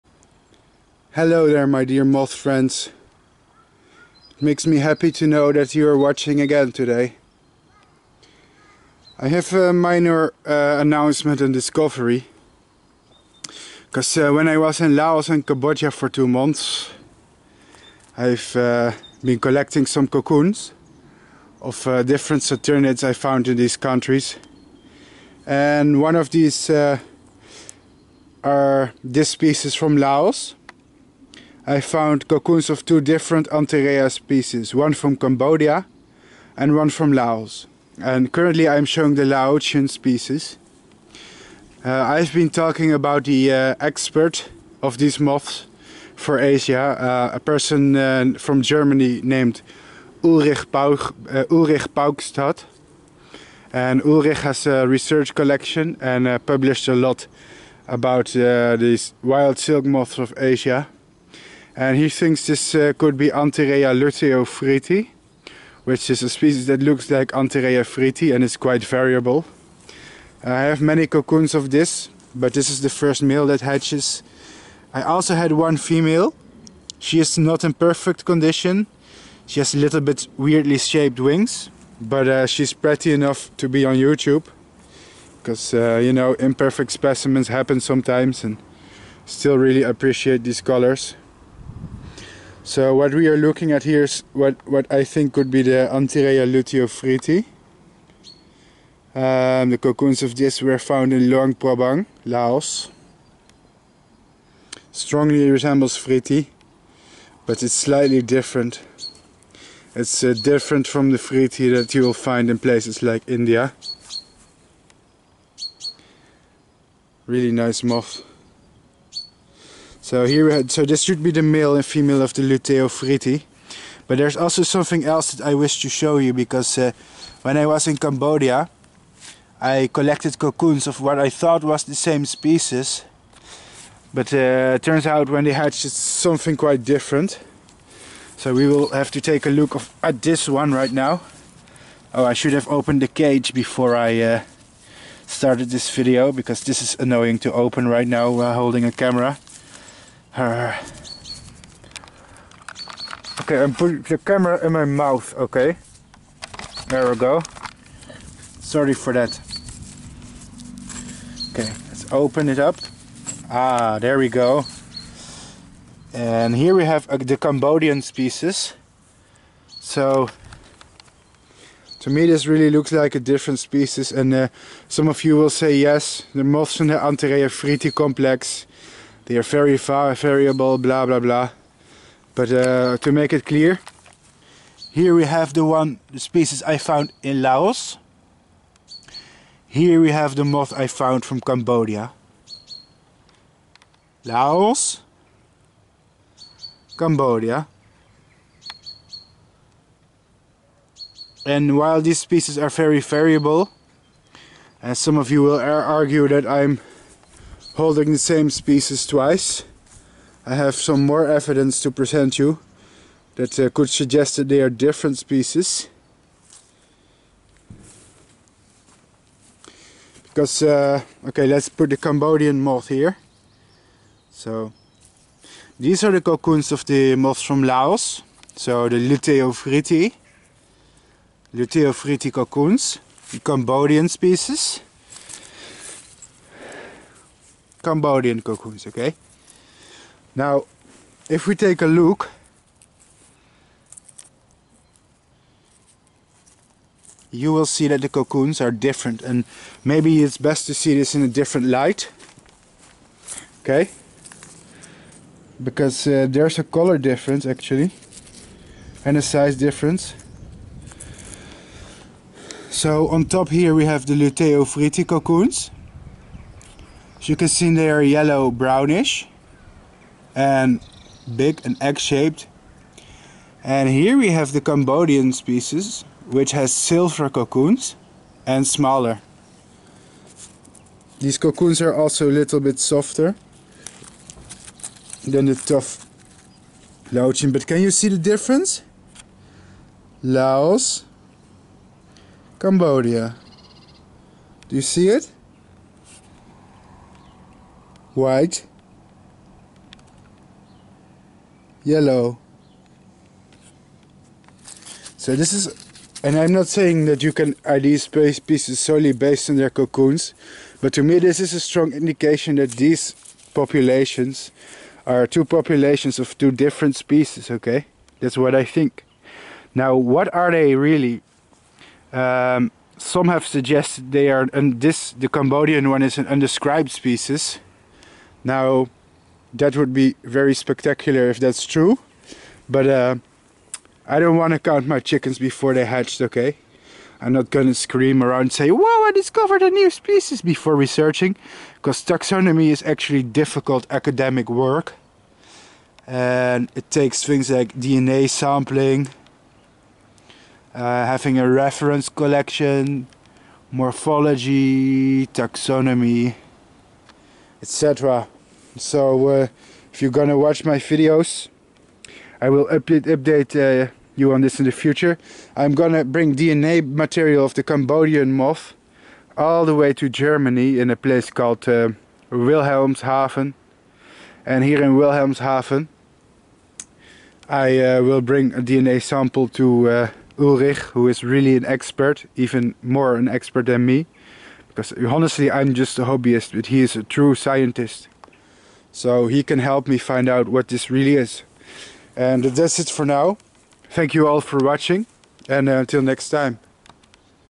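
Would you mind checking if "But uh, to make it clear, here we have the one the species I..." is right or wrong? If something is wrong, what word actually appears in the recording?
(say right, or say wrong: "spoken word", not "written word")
right.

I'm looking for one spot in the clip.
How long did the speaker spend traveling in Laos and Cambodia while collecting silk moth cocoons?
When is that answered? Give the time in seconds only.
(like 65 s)
16 s.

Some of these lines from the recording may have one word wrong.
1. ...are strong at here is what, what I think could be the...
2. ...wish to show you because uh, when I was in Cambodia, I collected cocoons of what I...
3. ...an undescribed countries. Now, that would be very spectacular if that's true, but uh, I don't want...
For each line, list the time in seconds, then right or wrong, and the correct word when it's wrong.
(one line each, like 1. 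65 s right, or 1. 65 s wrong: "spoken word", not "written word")
1. 93 s wrong: "looking", not "strong"
2. 125 s right
3. 326 s wrong: "species", not "countries".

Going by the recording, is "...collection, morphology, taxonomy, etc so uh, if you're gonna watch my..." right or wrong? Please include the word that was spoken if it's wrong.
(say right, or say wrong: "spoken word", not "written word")
right.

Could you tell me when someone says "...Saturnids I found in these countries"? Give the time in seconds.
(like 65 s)
22 s.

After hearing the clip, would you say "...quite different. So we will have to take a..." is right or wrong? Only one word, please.
right.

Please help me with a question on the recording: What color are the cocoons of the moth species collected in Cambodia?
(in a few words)
Silver.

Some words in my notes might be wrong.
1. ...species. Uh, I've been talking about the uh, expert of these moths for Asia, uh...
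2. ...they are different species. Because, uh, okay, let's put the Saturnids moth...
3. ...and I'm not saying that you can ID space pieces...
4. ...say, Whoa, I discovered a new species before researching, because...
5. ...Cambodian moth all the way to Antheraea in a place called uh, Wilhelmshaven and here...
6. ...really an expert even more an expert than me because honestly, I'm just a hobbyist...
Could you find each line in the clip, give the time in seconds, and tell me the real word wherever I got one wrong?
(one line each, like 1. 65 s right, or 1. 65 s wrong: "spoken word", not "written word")
1. 39 s right
2. 214 s wrong: "Cambodian", not "Saturnids"
3. 306 s right
4. 338 s right
5. 367 s wrong: "Germany", not "Antheraea"
6. 381 s right.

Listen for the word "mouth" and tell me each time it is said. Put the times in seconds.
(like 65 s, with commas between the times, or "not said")
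154 s.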